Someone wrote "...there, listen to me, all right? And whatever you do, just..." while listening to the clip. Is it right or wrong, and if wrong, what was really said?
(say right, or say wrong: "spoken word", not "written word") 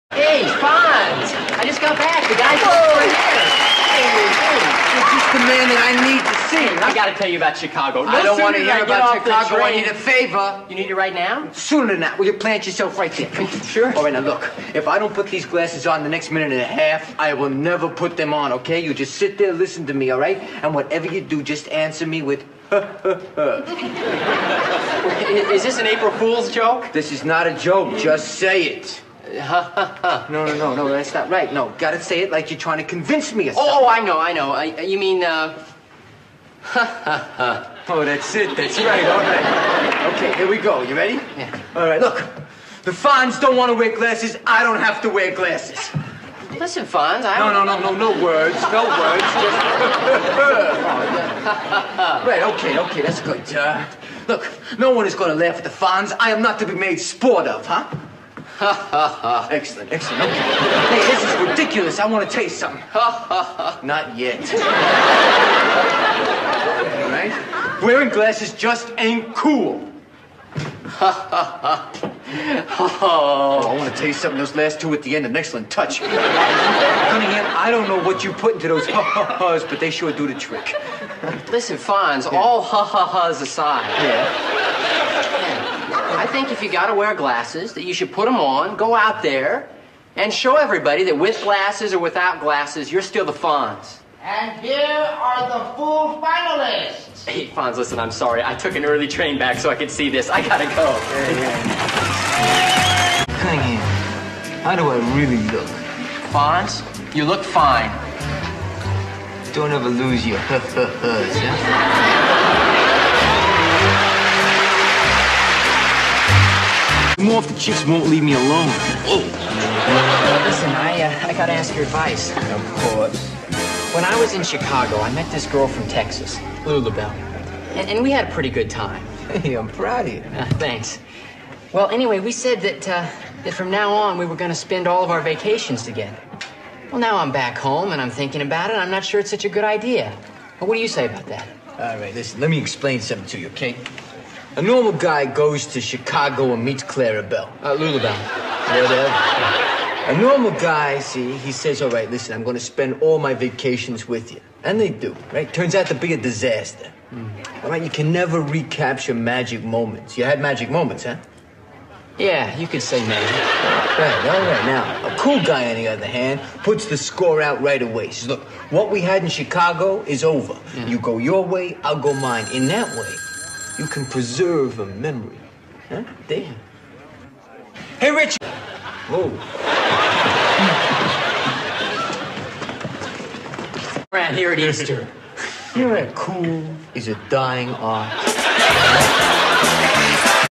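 right.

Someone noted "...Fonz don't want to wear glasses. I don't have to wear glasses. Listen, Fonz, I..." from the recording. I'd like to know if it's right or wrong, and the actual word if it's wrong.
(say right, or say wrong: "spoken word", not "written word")
right.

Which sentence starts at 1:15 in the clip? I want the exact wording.
Cunningham, I don't know what you put into those ha-ha-has, but they sure do the trick.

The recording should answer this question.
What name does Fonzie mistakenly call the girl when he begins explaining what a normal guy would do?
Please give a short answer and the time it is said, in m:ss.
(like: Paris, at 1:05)
Clara Bell, at 2:26.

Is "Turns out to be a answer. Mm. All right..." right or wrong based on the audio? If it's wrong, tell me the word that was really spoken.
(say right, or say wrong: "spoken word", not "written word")
wrong: "disaster", not "answer".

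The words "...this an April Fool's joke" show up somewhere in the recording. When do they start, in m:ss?
0:25.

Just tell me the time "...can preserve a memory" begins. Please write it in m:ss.
2:53.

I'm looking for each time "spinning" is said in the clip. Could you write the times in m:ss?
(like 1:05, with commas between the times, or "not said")
not said.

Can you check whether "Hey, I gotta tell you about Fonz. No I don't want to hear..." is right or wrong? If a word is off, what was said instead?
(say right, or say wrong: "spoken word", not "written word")
wrong: "Chicago", not "Fonz".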